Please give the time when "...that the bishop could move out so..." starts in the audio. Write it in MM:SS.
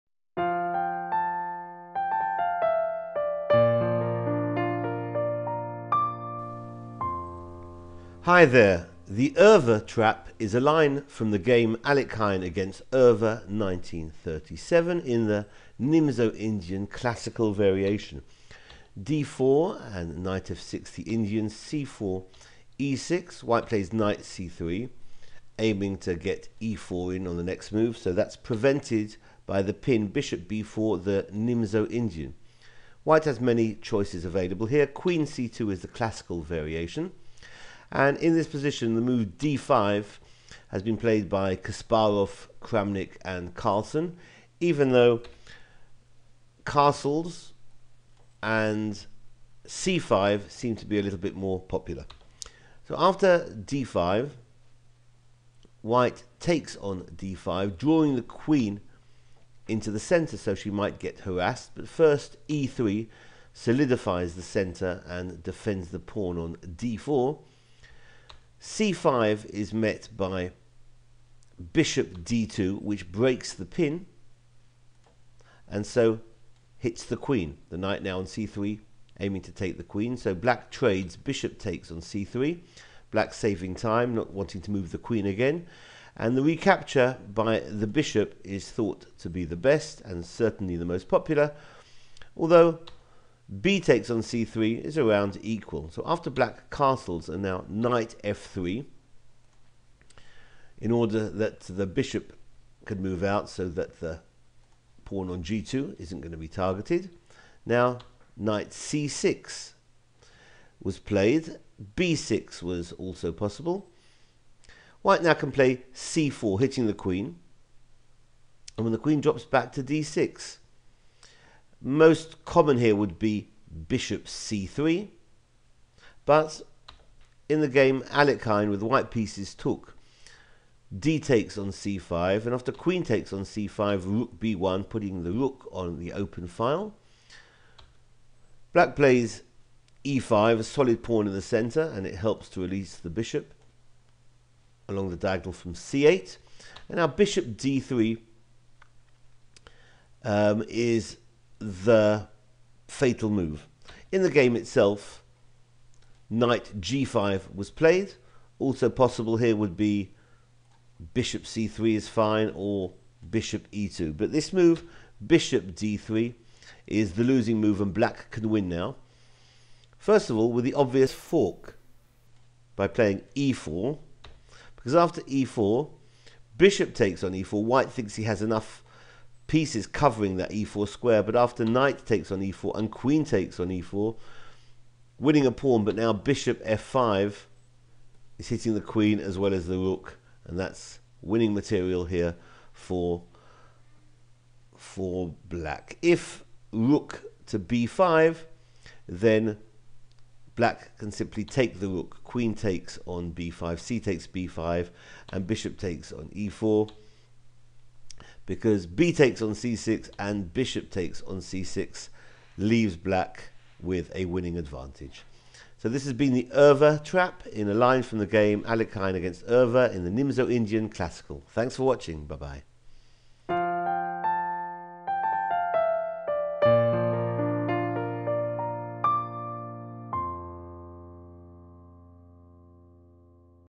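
01:41.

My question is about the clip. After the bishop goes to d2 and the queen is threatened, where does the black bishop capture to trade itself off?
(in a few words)
c3.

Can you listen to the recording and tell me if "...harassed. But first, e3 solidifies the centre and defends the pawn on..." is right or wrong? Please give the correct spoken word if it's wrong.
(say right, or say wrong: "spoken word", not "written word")
right.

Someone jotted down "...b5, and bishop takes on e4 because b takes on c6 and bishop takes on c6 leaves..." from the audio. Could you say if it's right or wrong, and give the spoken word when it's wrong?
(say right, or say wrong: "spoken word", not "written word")
right.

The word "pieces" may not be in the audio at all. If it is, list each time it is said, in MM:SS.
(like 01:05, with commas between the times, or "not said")
02:09, 02:59.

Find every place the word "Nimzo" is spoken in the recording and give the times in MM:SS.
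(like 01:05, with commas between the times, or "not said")
00:15, 00:31, 03:40.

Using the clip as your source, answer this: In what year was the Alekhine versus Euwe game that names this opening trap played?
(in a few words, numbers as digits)
1937.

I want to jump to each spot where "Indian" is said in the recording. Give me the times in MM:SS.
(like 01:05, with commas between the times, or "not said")
00:16, 00:21, 00:31, 03:40.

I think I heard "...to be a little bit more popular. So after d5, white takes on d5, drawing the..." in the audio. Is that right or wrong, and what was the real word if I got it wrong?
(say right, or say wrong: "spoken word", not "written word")
right.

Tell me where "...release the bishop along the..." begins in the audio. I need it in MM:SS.
02:22.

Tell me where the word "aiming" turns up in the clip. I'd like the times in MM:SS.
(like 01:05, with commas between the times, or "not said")
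00:25, 01:19.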